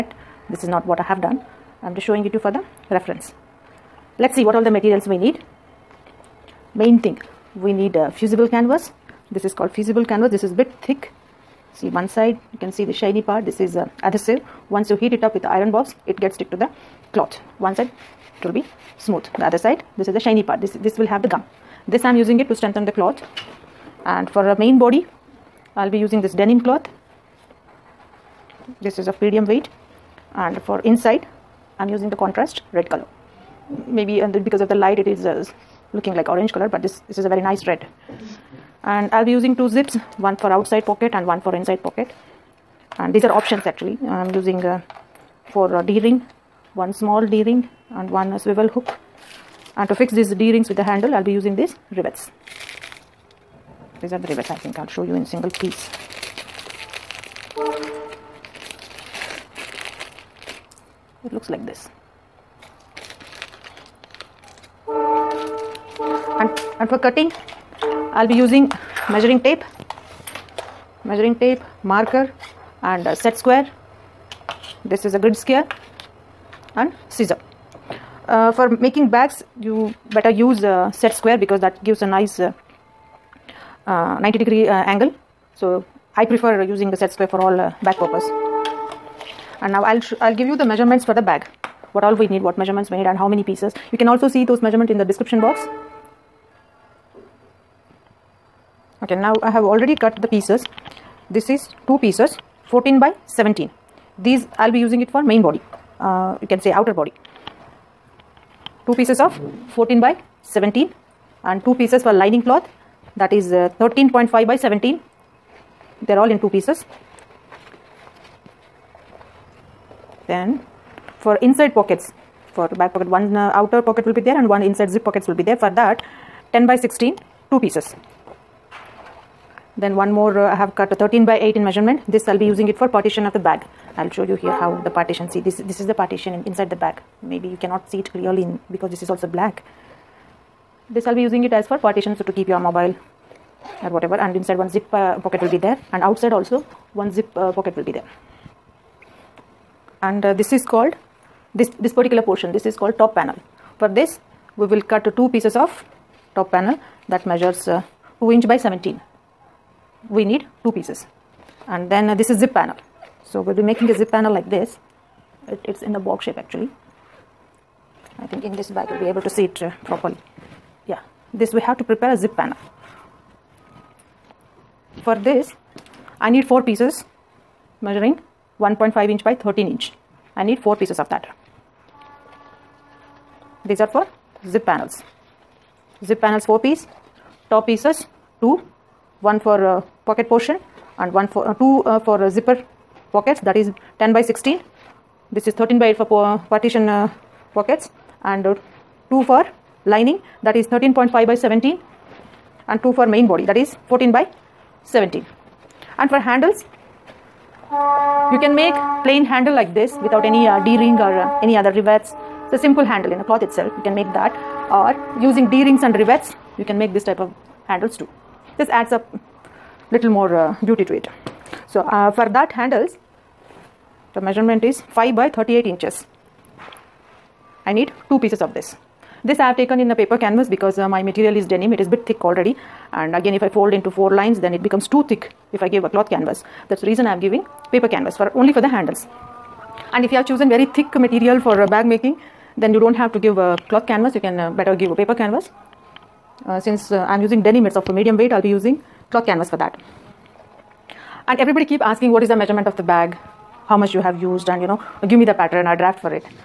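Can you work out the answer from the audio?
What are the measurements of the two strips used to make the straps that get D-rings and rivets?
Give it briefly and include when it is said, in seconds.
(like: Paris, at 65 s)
5 by 38 inches, at 224 s.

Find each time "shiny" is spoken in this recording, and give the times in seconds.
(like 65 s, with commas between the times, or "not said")
12 s, 20 s.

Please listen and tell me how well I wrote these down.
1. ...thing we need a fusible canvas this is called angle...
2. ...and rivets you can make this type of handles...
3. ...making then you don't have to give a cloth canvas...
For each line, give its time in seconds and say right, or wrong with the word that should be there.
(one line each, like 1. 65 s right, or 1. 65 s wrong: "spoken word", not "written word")
1. 7 s wrong: "fusible", not "angle"
2. 215 s right
3. 241 s right.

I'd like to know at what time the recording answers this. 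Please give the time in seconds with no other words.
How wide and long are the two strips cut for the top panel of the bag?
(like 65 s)
158 s.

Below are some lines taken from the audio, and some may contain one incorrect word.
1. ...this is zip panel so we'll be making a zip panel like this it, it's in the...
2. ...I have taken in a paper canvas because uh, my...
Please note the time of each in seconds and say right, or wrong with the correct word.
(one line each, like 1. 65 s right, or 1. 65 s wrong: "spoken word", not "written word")
1. 162 s right
2. 229 s right.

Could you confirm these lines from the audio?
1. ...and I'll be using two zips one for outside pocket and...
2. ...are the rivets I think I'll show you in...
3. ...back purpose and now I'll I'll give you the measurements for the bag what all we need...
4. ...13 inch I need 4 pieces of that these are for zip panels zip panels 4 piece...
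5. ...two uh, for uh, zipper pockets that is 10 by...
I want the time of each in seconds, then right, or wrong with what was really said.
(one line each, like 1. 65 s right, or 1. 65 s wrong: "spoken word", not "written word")
1. 38 s right
2. 54 s right
3. 87 s right
4. 179 s right
5. 191 s right.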